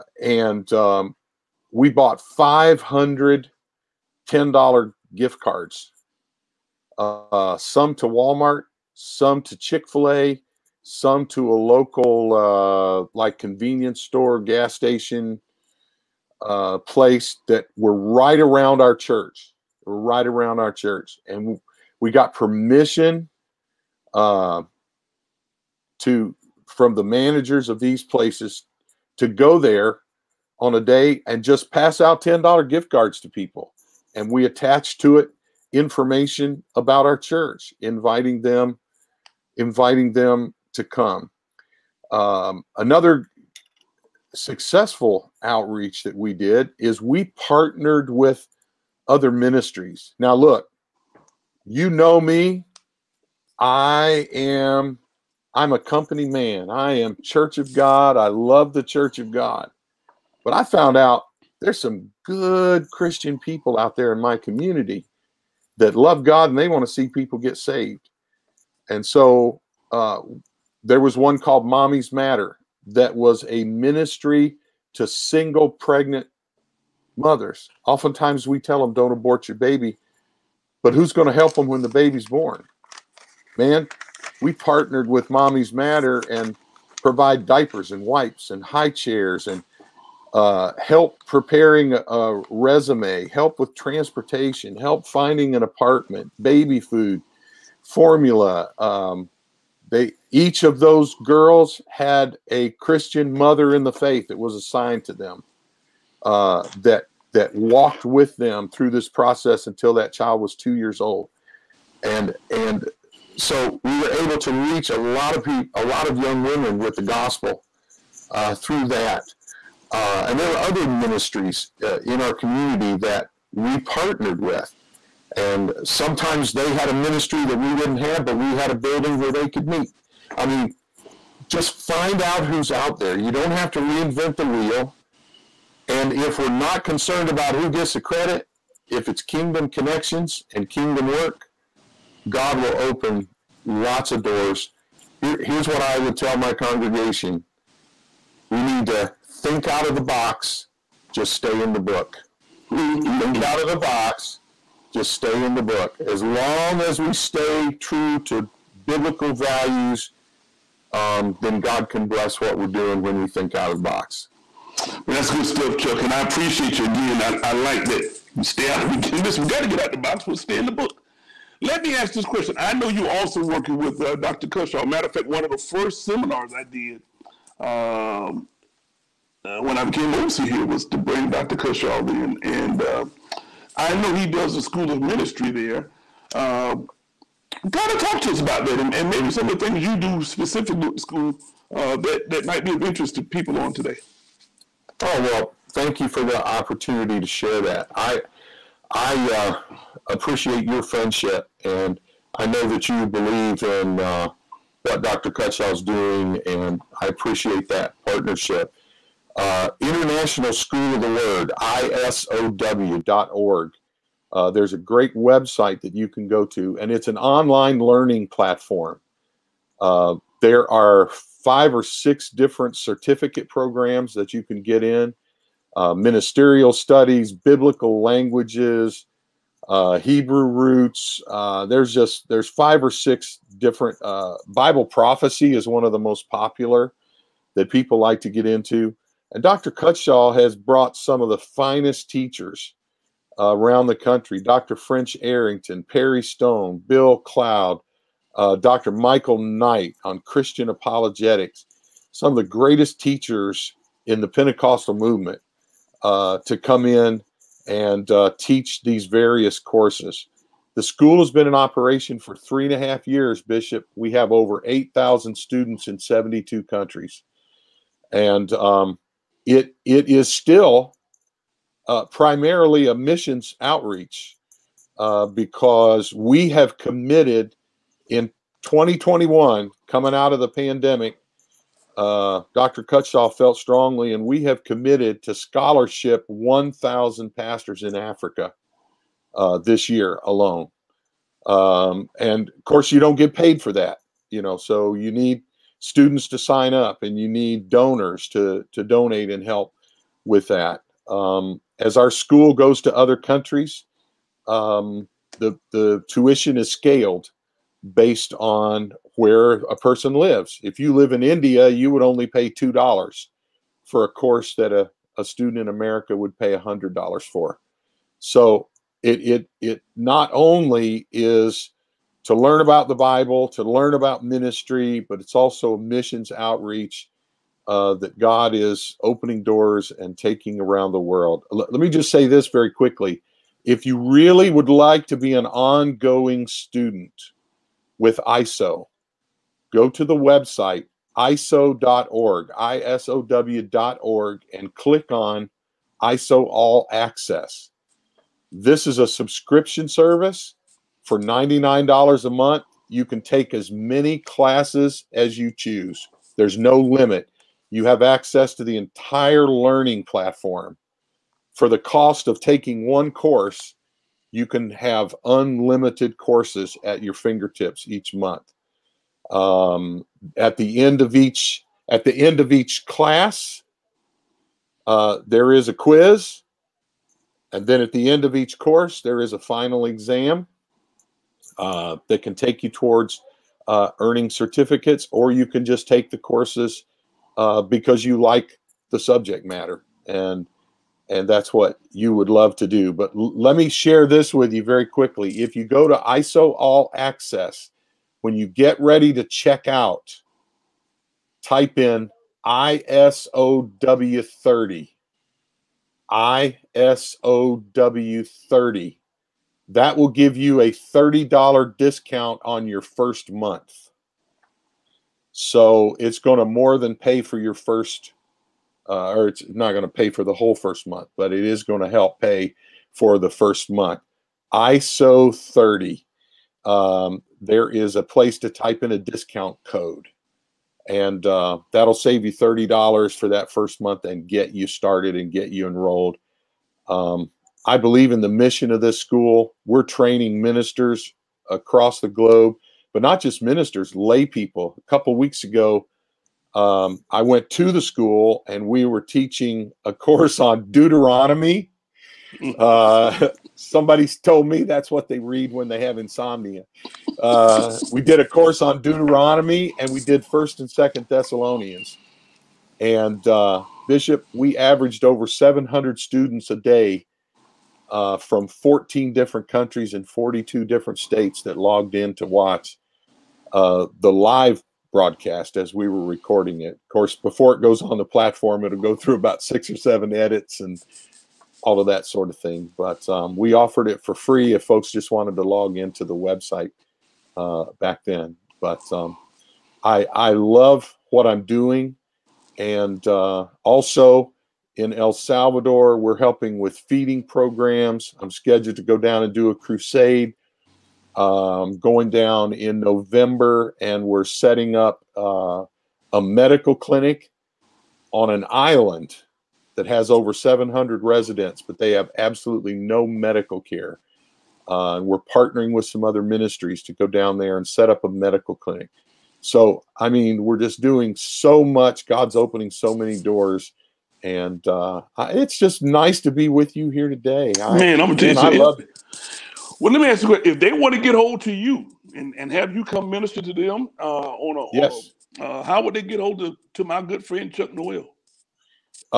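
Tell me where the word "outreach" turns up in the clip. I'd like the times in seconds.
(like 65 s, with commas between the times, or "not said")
45 s, 273 s, 326 s.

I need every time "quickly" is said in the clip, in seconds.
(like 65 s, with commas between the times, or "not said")
332 s, 394 s.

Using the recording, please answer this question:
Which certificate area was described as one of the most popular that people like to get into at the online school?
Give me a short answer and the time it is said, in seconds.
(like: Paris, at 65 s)
Bible prophecy, at 234 s.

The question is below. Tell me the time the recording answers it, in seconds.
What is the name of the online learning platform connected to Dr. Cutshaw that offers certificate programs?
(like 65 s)
209 s.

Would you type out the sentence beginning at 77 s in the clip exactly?
Oftentimes we tell them, don't abort your baby, but who's going to help them when the baby's born?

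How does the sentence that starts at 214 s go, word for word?
Uh, there's a great website that you can go to, and it's an online learning platform.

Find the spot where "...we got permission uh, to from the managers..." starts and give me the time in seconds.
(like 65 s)
21 s.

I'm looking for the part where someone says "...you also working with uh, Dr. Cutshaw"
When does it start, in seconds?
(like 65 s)
172 s.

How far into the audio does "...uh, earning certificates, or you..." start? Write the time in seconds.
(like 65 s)
383 s.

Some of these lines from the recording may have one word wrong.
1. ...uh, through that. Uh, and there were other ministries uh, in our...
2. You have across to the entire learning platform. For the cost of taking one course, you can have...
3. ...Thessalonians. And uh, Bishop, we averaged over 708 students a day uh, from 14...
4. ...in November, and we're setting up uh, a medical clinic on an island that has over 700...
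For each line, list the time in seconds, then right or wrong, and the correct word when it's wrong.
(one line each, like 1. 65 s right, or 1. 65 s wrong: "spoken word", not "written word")
1. 118 s right
2. 357 s wrong: "access", not "across"
3. 461 s wrong: "700", not "708"
4. 502 s right.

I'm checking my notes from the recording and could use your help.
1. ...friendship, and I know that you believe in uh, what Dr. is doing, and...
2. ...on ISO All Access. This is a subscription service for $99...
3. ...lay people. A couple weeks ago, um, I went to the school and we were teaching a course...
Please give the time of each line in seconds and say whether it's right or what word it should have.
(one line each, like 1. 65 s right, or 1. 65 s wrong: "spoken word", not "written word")
1. 200 s right
2. 345 s right
3. 443 s right.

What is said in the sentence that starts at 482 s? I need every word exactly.
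But um, we offered it for free if folks just wanted to log into the website uh, back then.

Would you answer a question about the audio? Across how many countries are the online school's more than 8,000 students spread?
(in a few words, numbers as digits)
72.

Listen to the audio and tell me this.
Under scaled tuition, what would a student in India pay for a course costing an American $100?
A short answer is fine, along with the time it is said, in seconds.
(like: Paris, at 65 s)
$2, at 312 s.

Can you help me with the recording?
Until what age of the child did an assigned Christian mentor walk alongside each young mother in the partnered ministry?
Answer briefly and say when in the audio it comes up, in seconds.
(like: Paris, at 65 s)
2 years old, at 110 s.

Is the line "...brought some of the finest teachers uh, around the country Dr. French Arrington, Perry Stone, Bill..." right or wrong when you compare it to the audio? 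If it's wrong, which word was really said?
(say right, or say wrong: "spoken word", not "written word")
right.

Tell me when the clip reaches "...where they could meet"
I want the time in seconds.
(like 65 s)
129 s.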